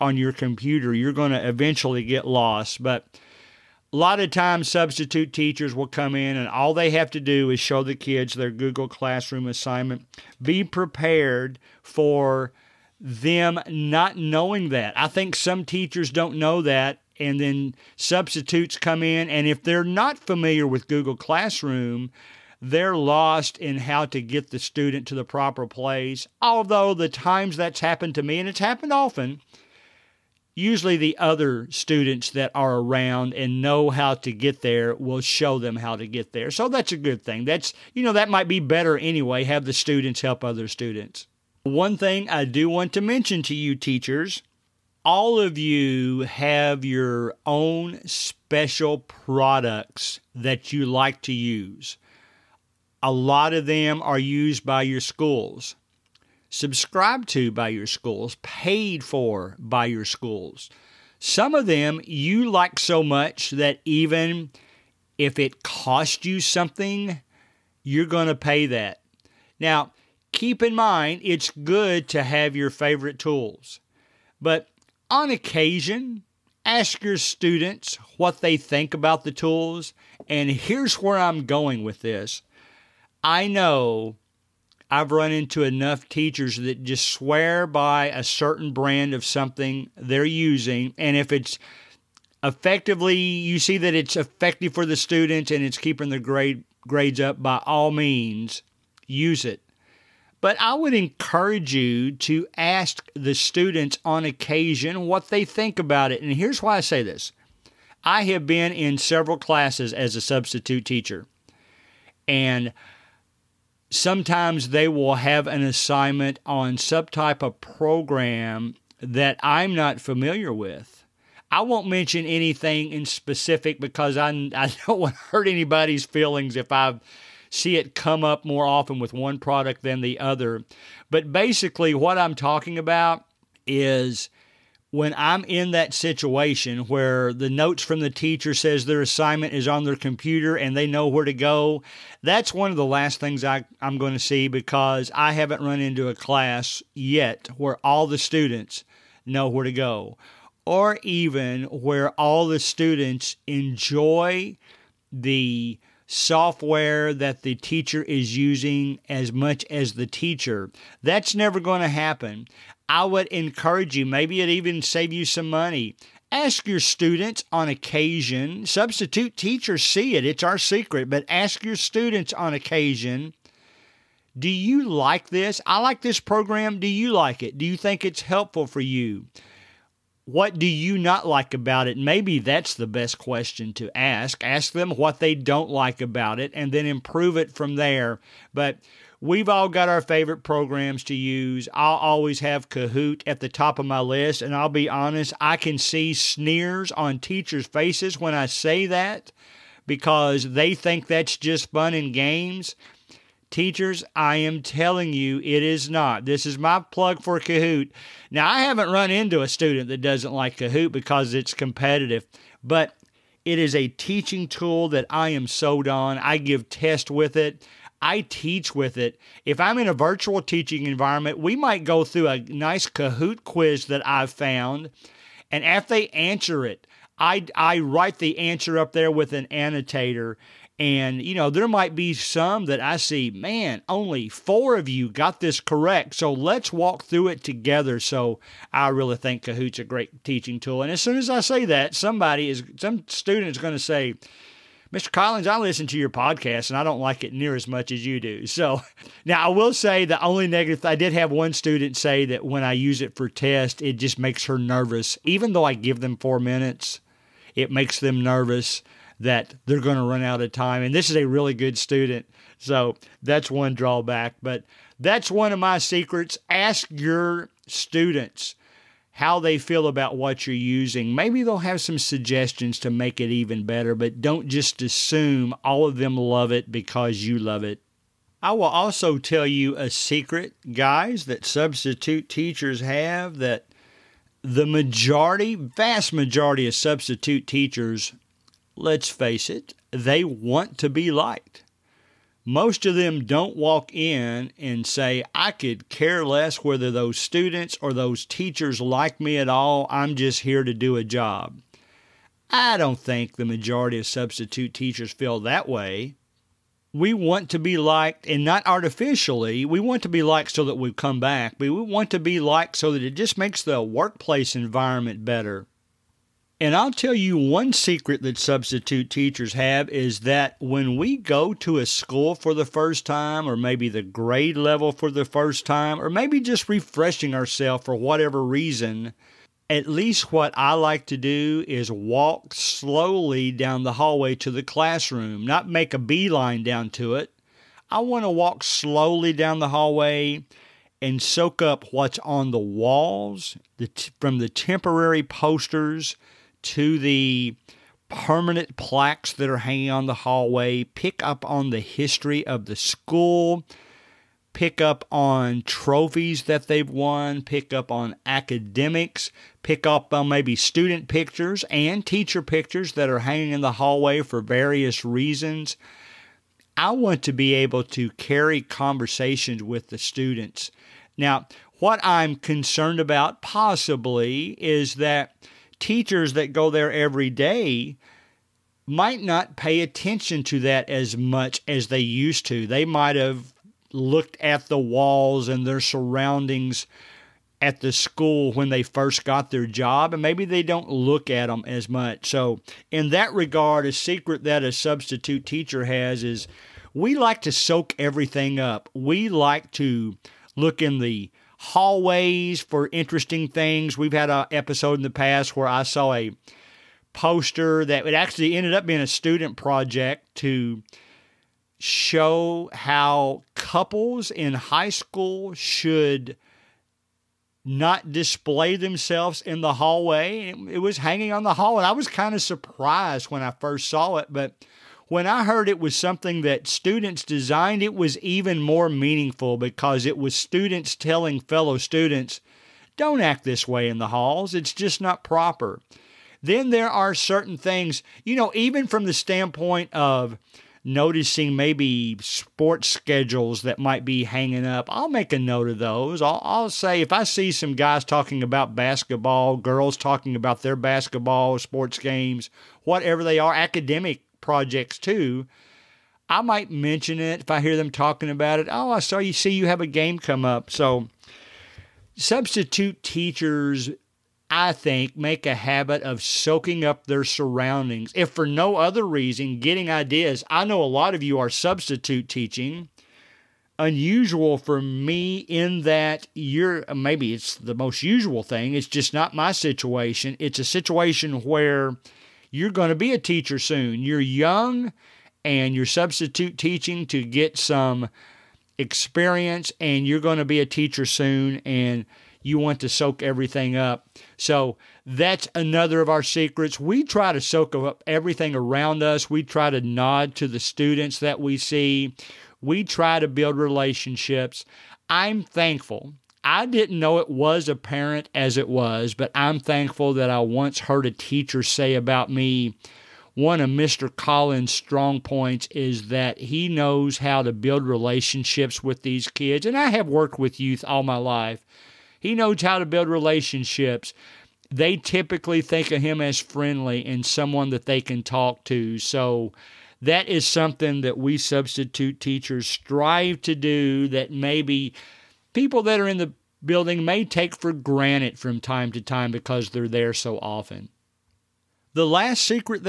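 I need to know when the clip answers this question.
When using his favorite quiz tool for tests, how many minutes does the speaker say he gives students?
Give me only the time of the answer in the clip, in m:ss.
4:16.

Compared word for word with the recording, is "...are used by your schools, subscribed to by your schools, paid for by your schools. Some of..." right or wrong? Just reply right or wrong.
right.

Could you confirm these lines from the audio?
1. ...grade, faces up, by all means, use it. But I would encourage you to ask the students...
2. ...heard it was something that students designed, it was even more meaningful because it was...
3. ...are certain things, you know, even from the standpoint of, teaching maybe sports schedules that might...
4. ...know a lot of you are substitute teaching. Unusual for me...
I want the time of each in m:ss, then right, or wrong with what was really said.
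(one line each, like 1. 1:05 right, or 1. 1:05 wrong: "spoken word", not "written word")
1. 1:36 wrong: "grades", not "faces"
2. 7:05 right
3. 7:16 wrong: "noticing", not "teaching"
4. 7:50 right.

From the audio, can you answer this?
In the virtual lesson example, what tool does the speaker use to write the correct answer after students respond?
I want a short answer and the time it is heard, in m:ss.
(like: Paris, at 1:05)
an annotator, at 3:49.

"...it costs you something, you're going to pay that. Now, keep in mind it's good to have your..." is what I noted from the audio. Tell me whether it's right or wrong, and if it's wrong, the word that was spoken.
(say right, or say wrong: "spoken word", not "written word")
right.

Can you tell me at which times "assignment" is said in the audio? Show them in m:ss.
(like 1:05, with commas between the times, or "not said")
0:09, 1:55, 2:19.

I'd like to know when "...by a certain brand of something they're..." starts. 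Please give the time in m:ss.
1:27.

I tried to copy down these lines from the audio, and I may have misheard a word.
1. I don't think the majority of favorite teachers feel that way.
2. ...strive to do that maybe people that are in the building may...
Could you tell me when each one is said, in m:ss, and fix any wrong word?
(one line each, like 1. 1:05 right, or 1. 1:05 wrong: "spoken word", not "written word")
1. 5:02 wrong: "substitute", not "favorite"
2. 8:52 right.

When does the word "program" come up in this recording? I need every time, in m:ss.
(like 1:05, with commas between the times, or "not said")
1:57, 2:56, 3:10.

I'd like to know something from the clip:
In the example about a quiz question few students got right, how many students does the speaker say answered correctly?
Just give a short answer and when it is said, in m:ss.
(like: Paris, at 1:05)
4, at 3:53.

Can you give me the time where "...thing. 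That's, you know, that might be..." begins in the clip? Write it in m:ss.
0:37.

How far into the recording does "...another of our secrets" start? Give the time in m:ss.
8:15.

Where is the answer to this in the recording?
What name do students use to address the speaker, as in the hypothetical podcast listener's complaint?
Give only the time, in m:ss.
4:04.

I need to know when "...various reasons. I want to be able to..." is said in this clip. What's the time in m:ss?
6:04.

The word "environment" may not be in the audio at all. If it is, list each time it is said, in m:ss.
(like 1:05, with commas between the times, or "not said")
3:40, 5:14.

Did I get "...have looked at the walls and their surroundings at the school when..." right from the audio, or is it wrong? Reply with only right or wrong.
right.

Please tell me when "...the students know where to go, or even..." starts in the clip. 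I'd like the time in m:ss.
2:28.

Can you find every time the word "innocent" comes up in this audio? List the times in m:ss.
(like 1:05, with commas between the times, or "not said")
not said.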